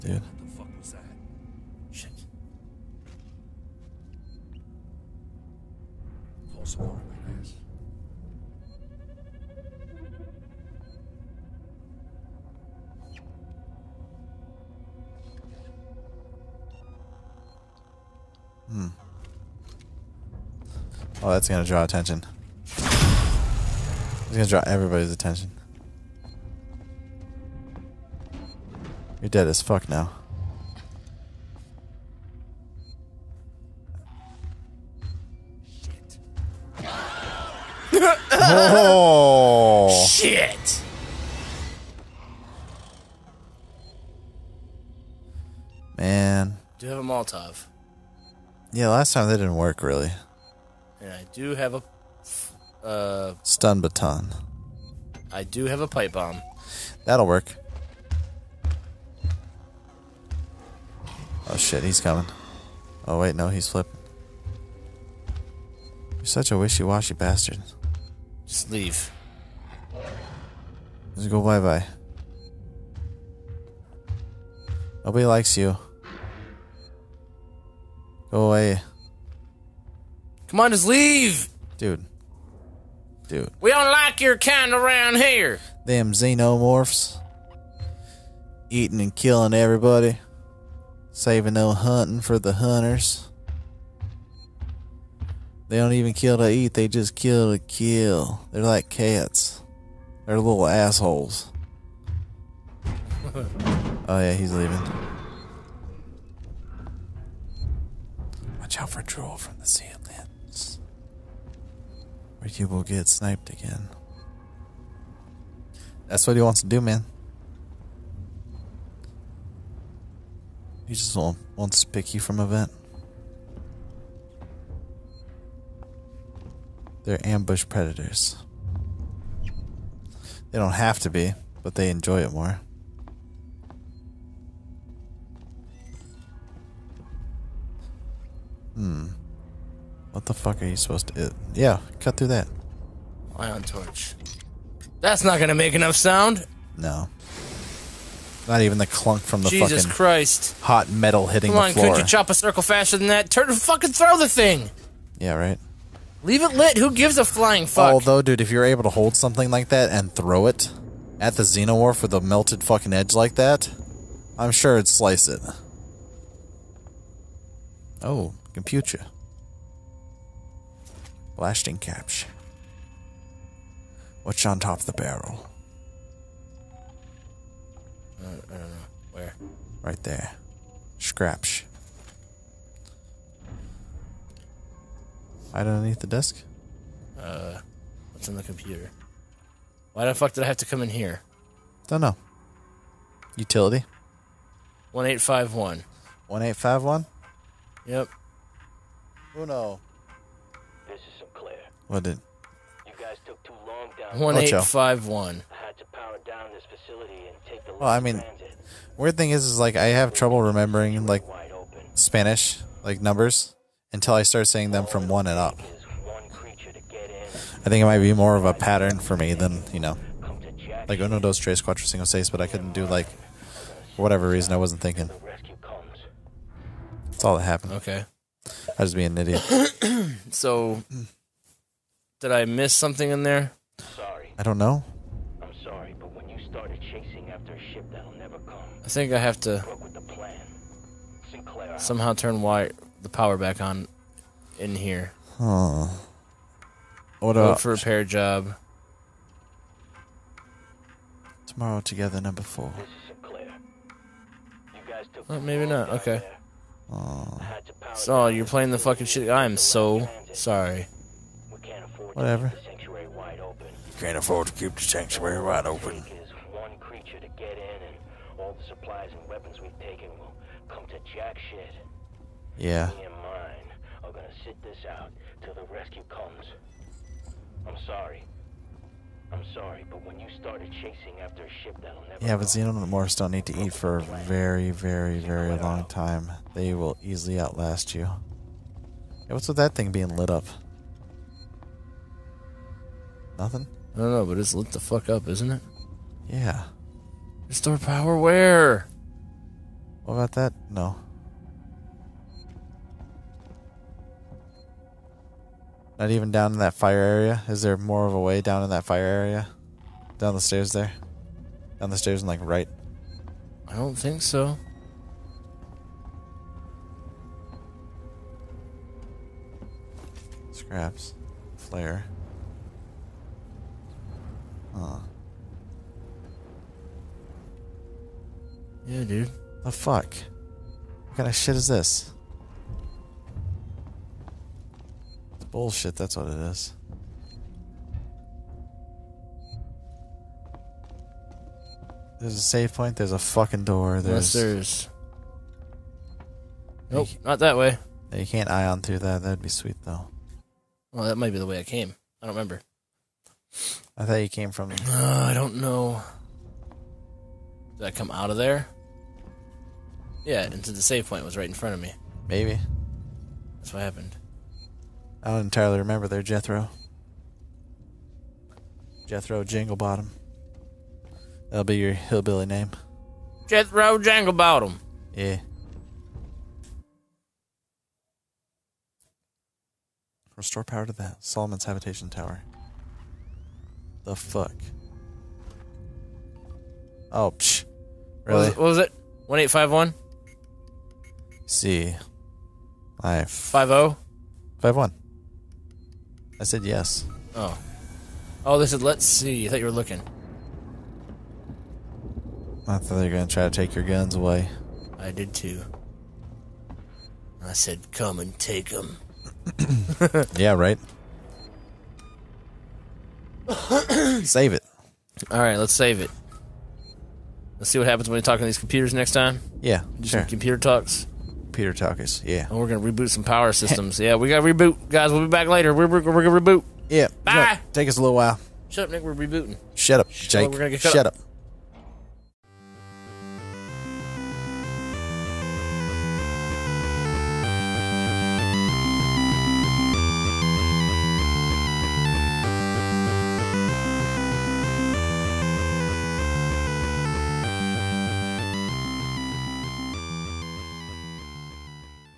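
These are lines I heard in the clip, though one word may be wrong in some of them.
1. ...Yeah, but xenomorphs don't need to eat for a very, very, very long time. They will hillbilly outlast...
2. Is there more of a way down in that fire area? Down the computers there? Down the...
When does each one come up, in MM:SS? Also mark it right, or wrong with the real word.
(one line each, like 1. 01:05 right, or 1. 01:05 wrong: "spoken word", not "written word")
1. 04:42 wrong: "easily", not "hillbilly"
2. 05:07 wrong: "stairs", not "computers".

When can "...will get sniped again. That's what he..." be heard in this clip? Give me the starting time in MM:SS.
01:52.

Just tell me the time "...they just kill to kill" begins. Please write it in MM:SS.
01:36.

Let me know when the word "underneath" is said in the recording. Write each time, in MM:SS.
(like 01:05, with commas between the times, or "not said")
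03:05.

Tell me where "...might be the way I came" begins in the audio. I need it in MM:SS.
05:51.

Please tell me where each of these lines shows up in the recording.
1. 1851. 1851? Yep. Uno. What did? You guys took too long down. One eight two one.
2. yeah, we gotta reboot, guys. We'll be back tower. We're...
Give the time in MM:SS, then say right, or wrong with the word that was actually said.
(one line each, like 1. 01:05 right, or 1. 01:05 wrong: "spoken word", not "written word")
1. 03:14 wrong: "five", not "two"
2. 07:03 wrong: "later", not "tower".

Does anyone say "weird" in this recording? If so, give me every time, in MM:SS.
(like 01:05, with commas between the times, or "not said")
03:28.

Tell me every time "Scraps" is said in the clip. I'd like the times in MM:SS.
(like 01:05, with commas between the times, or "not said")
03:00, 05:20.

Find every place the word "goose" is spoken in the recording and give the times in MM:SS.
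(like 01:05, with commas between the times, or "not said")
not said.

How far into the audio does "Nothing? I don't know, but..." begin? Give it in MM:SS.
04:53.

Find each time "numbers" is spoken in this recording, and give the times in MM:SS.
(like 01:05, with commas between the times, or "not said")
03:33, 04:12.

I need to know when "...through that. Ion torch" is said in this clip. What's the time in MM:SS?
02:22.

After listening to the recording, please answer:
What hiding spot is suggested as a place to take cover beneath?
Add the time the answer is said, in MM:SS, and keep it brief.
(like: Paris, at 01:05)
the desk, at 03:05.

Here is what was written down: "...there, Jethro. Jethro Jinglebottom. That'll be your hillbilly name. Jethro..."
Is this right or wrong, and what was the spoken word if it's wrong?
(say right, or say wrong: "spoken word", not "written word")
right.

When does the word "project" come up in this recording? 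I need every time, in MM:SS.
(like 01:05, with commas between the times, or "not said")
not said.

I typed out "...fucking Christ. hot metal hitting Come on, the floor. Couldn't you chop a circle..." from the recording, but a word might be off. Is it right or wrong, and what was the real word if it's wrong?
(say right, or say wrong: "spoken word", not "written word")
right.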